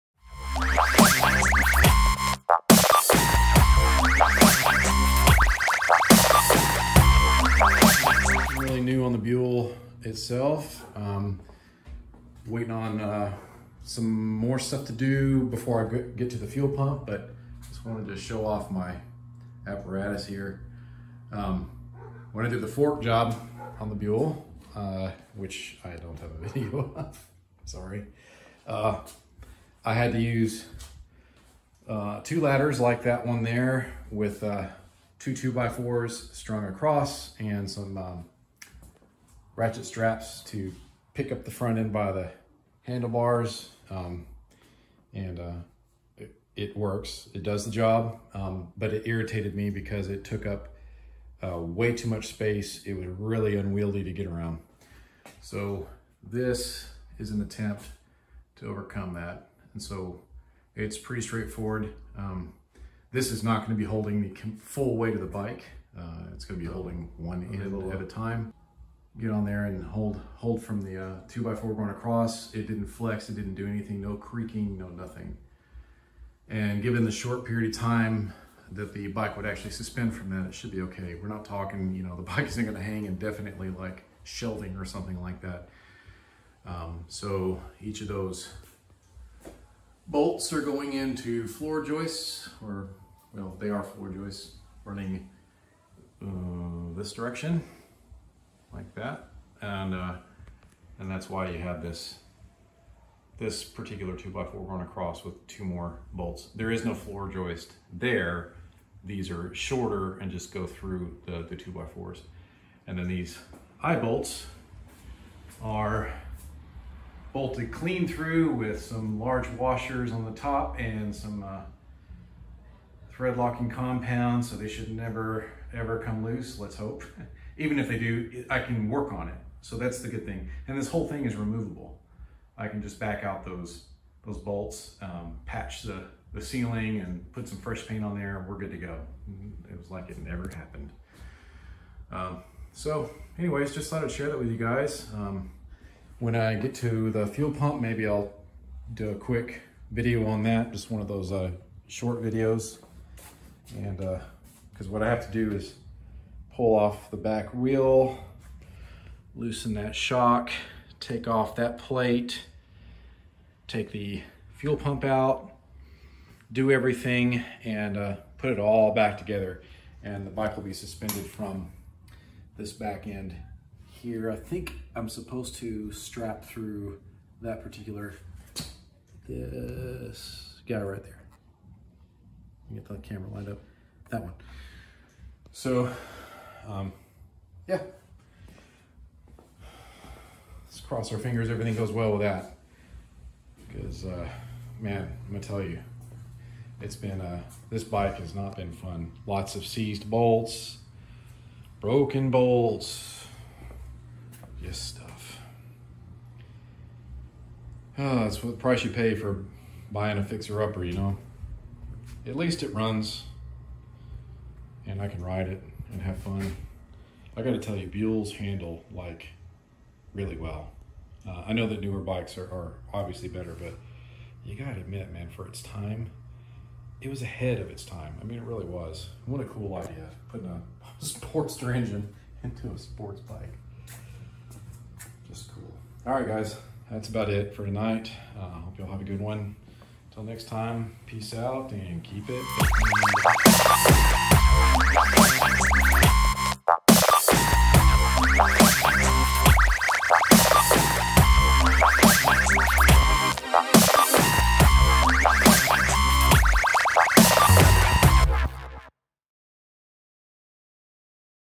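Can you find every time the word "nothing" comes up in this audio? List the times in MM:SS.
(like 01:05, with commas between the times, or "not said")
01:14.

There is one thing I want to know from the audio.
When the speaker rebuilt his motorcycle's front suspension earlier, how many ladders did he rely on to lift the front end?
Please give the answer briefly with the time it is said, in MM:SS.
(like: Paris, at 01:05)
2, at 00:32.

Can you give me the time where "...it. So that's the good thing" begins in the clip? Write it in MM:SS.
02:09.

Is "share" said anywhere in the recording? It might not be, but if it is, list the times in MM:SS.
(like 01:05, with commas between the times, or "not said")
02:24.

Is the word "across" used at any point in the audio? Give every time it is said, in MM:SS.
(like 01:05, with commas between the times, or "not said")
00:36, 01:11, 01:44.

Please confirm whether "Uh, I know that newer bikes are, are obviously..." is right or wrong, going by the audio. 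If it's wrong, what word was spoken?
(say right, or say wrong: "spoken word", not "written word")
right.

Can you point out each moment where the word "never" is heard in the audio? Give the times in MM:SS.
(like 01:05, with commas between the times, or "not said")
02:04, 02:20.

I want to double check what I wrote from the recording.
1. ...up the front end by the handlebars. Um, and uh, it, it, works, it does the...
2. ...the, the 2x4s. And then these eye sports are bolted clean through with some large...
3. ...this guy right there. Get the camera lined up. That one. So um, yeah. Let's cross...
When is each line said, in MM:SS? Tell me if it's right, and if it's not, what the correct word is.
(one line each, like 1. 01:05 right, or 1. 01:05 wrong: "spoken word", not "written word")
1. 00:41 right
2. 01:51 wrong: "bolts", not "sports"
3. 02:59 right.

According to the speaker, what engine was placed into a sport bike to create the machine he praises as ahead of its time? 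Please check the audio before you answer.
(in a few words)
Sportster engine.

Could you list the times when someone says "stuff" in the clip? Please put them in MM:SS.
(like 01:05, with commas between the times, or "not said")
00:14, 03:24.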